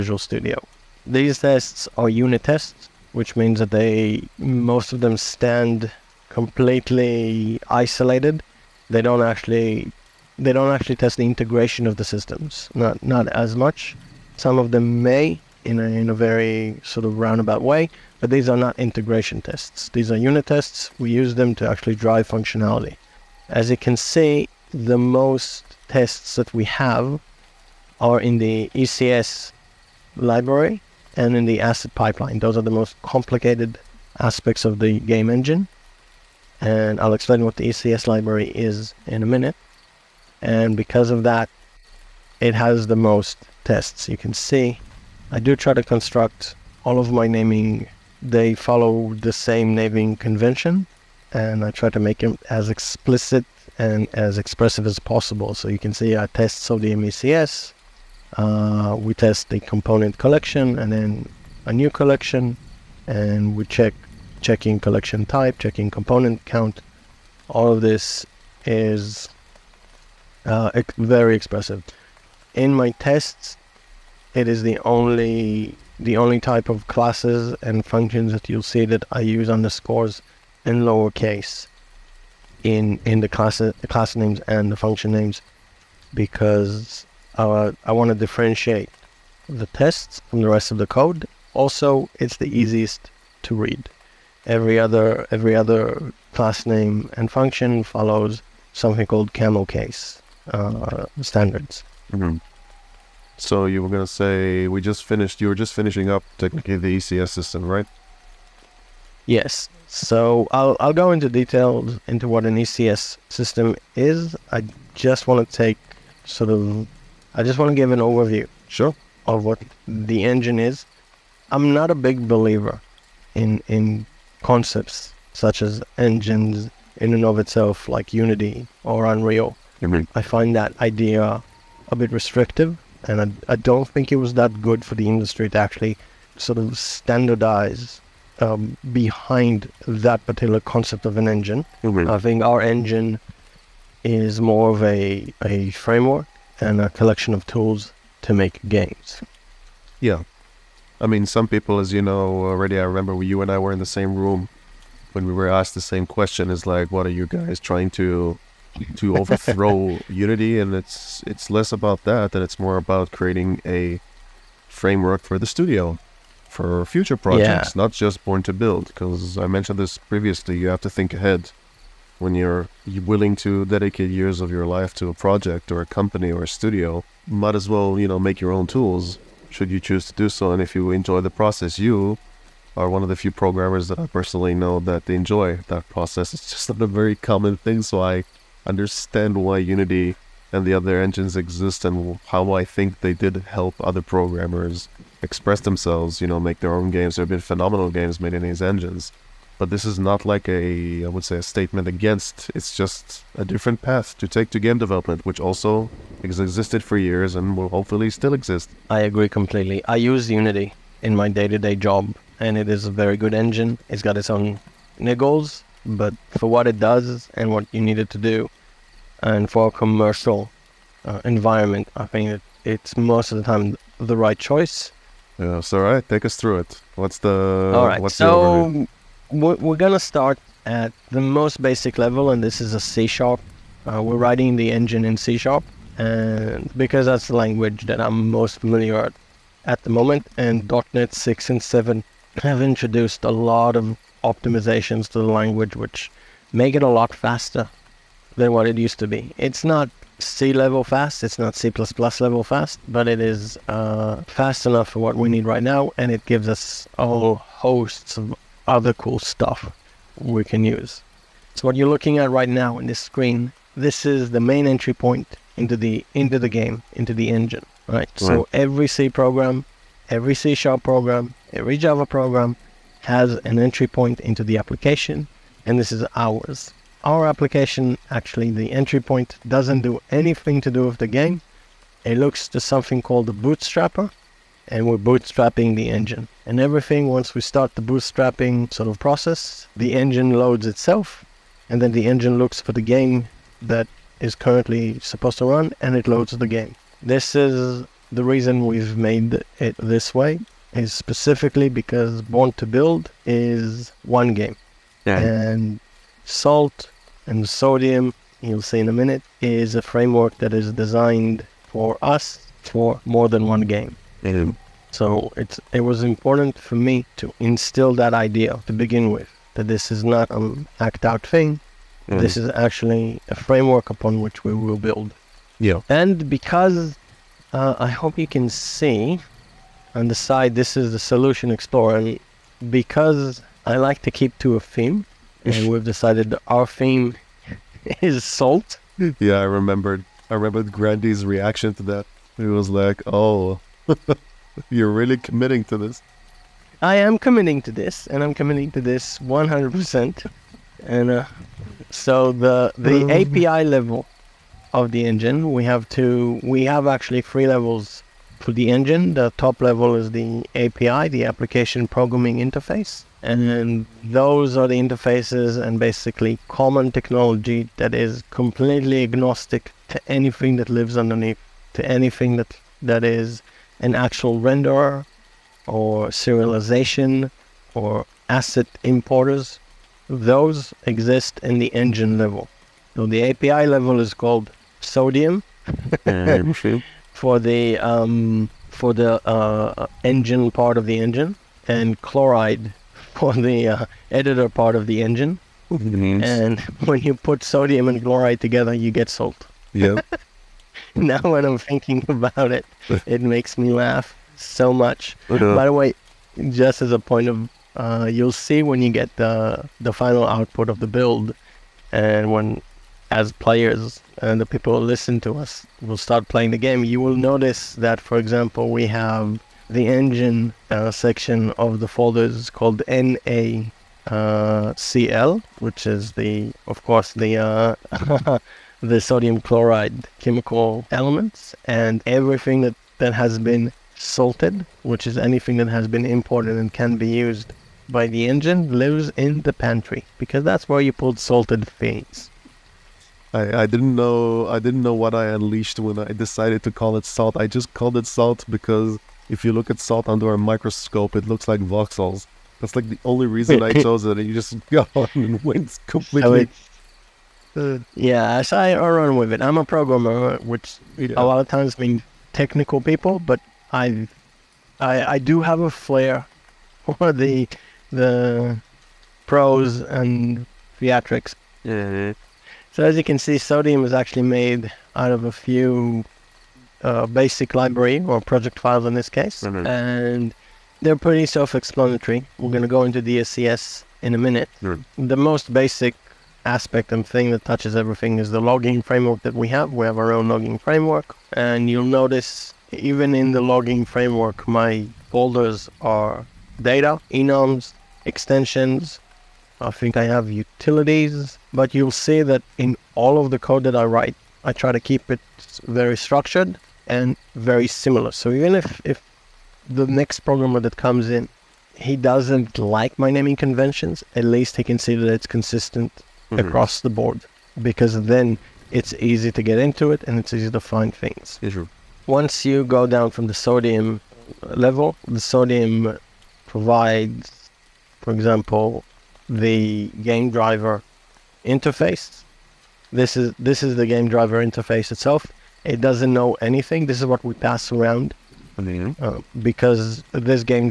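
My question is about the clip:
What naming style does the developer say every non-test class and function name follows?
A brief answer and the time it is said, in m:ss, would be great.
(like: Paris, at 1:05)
Camel case, at 1:39.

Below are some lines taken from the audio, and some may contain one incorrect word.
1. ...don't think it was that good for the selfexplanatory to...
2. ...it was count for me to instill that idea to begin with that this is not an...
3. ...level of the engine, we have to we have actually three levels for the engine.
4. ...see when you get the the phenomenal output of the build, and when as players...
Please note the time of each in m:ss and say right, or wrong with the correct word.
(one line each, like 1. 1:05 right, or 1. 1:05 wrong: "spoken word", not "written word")
1. 2:13 wrong: "industry", not "selfexplanatory"
2. 5:15 wrong: "important", not "count"
3. 5:53 right
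4. 6:48 wrong: "final", not "phenomenal".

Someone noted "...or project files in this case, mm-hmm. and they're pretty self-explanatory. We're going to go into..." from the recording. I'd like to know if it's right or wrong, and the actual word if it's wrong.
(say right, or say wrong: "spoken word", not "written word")
right.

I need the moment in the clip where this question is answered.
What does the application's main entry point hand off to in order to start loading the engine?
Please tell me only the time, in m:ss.
4:43.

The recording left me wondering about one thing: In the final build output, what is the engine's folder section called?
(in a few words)
NaCl.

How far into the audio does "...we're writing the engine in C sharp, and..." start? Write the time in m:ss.
3:54.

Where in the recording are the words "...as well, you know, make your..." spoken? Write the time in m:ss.
2:57.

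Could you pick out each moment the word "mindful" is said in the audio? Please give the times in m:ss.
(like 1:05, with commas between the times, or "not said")
not said.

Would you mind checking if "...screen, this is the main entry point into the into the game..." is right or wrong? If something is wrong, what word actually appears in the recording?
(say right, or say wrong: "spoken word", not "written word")
right.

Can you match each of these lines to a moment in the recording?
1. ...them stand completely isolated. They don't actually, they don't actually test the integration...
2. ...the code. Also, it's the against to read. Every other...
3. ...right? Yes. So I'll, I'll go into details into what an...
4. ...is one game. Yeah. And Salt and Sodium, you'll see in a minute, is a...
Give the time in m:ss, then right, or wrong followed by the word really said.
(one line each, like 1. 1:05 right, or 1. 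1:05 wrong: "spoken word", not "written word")
1. 0:04 right
2. 1:30 wrong: "easiest", not "against"
3. 1:47 right
4. 5:03 right.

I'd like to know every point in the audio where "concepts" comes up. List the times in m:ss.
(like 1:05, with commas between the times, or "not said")
2:04, 2:20.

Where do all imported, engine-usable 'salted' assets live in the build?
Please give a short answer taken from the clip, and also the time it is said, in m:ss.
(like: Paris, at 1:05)
The pantry, at 7:19.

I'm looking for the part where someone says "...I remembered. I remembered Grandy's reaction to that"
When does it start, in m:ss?
5:39.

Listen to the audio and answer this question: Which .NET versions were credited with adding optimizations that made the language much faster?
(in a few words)
.NET 6 and 7.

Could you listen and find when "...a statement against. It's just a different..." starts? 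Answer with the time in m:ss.
3:21.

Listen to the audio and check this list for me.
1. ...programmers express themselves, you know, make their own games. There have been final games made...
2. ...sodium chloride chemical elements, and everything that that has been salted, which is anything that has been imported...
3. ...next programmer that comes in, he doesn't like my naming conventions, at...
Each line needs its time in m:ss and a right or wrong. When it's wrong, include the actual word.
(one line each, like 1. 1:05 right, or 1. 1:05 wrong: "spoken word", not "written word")
1. 3:14 wrong: "phenomenal", not "final"
2. 7:08 right
3. 8:29 right.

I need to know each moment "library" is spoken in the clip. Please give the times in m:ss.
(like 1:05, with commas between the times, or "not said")
0:30, 0:38, 7:57.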